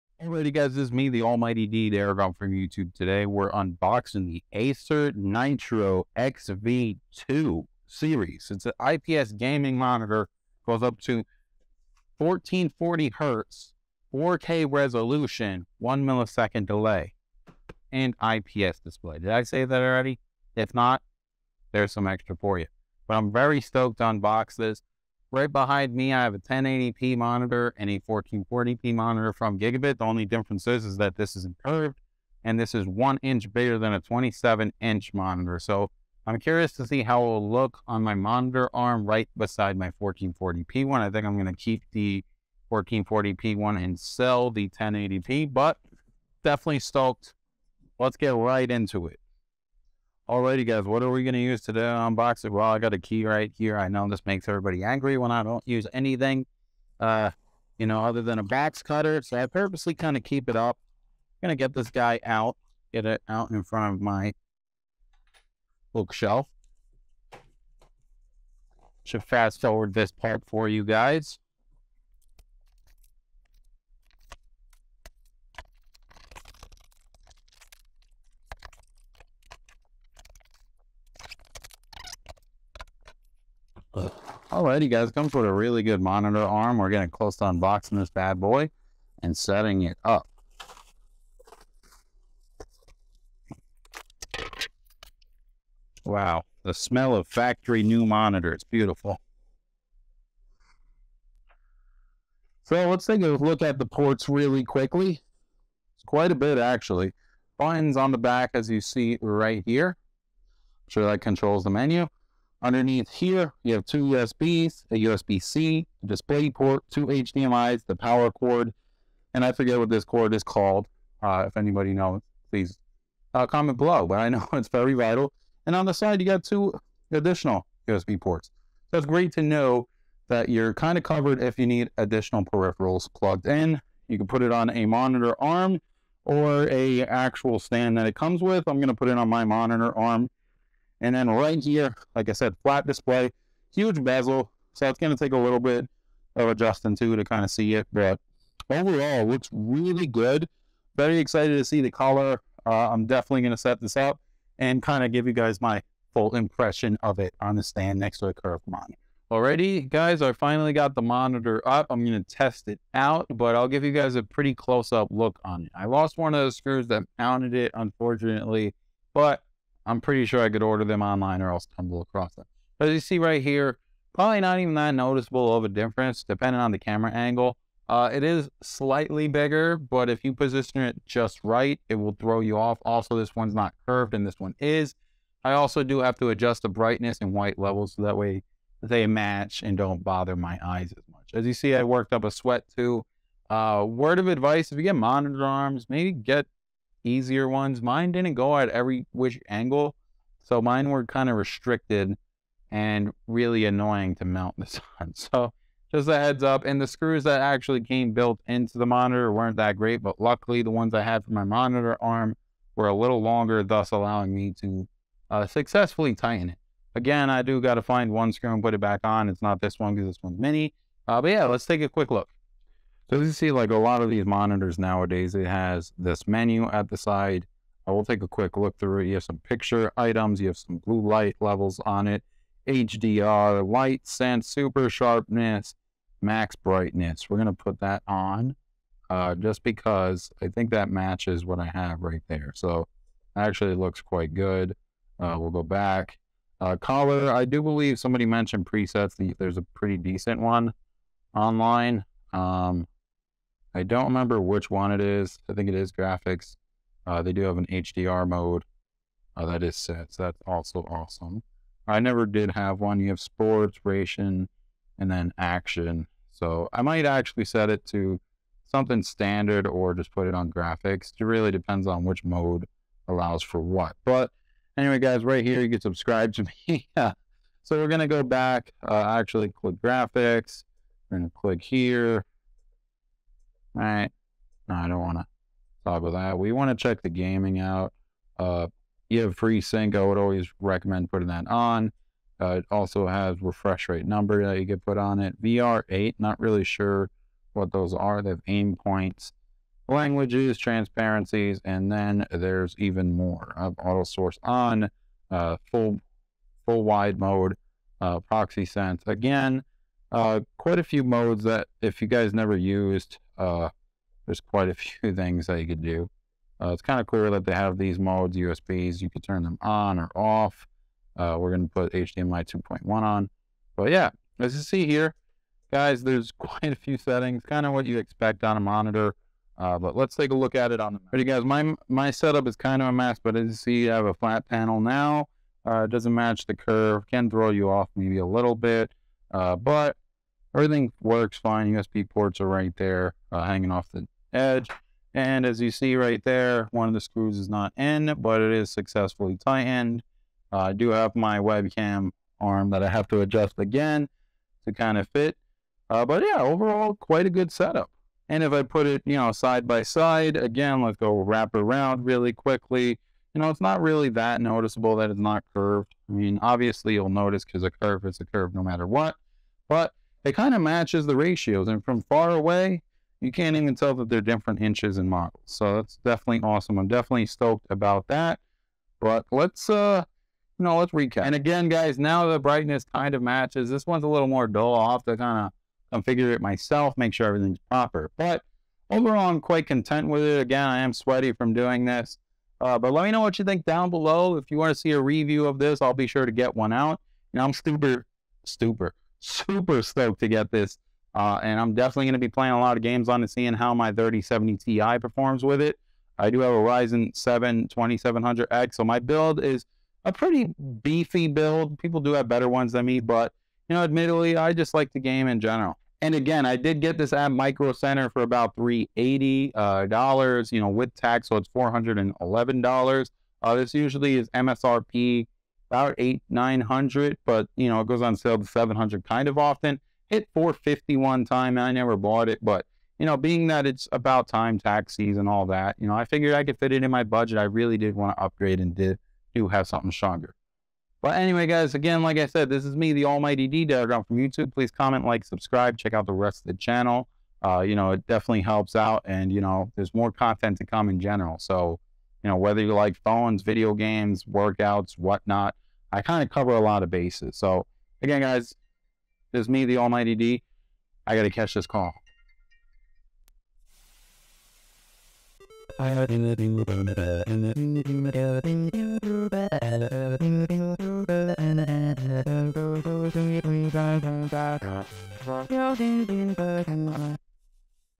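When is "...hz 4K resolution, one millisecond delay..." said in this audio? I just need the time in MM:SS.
00:13.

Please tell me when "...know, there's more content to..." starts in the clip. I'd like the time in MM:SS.
07:29.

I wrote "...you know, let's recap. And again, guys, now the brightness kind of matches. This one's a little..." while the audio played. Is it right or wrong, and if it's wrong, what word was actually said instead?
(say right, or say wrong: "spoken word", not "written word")
right.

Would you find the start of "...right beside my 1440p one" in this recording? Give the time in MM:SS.
00:39.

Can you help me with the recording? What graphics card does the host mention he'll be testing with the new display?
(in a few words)
3070 Ti.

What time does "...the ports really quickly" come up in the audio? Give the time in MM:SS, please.
01:43.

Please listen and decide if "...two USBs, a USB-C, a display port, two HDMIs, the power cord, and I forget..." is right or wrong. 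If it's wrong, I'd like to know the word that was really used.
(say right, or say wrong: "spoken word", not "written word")
right.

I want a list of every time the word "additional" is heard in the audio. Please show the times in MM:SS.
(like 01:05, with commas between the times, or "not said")
02:07, 02:11.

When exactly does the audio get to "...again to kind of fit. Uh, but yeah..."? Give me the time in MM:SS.
05:53.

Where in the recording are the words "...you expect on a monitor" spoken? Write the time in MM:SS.
05:27.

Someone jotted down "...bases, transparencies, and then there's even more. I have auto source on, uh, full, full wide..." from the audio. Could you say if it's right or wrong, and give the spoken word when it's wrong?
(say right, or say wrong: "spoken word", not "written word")
wrong: "languages", not "bases".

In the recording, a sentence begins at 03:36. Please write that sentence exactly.
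Again, I do got to find one screw and put it back on.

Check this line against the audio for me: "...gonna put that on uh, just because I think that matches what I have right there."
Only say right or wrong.
right.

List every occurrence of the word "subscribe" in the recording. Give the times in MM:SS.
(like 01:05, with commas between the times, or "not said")
04:35, 07:25.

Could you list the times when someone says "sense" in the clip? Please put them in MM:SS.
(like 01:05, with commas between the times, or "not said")
03:54, 05:08.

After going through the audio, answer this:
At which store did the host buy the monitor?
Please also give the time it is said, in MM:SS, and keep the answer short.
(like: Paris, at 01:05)
Micro Center, at 06:57.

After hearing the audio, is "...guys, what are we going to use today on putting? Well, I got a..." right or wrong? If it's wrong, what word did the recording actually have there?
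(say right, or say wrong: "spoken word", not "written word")
wrong: "unboxing", not "putting".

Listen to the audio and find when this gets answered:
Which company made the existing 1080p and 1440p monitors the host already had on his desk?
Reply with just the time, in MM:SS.
00:29.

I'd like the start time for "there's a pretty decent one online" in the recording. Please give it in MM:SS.
04:09.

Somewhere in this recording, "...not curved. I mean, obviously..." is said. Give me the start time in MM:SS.
06:05.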